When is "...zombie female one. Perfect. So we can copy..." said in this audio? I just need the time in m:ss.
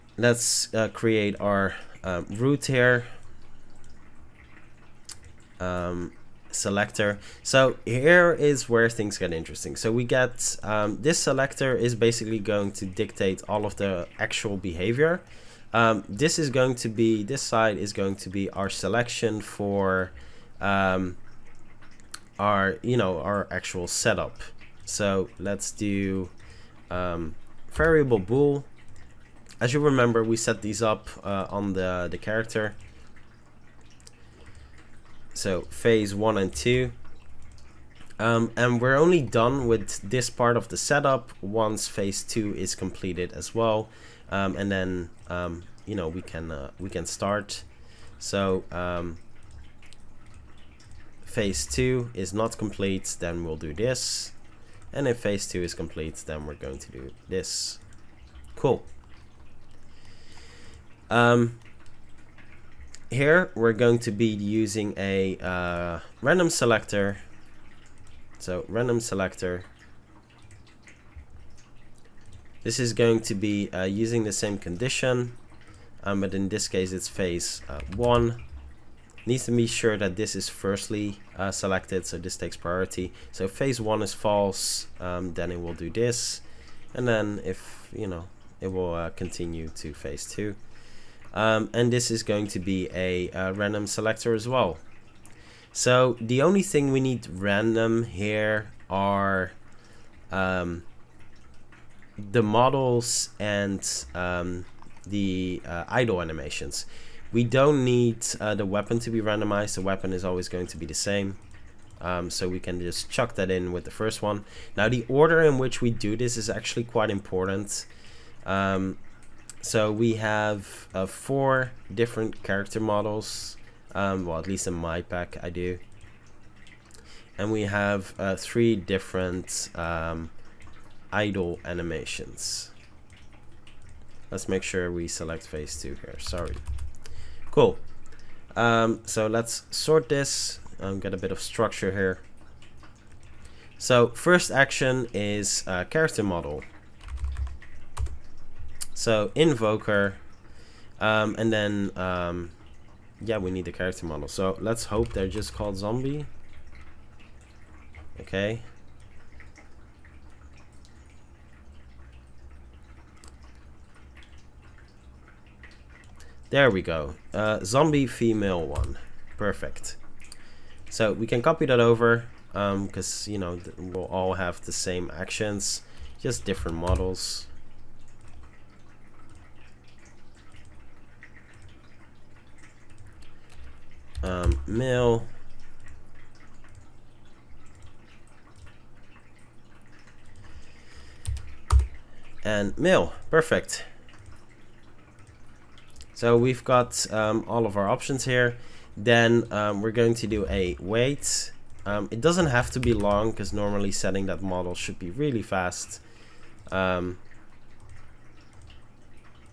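2:47.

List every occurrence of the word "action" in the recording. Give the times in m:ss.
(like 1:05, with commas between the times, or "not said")
2:24, 2:55.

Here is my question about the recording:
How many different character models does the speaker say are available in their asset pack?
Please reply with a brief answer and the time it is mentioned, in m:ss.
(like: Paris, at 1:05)
4, at 2:01.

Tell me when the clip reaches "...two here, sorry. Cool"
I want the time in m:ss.
2:15.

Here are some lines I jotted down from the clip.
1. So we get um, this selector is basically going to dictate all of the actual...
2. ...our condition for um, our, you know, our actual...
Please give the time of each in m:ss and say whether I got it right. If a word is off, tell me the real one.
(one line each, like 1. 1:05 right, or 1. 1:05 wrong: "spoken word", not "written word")
1. 0:09 right
2. 0:18 wrong: "selection", not "condition".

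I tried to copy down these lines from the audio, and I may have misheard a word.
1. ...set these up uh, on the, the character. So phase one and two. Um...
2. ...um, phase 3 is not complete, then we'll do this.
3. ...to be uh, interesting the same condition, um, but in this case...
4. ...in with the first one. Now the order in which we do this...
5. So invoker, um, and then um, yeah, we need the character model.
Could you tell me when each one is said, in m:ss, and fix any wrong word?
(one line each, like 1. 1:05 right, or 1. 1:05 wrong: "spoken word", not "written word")
1. 0:30 right
2. 0:48 wrong: "2", not "3"
3. 1:13 wrong: "using", not "interesting"
4. 1:53 right
5. 2:28 right.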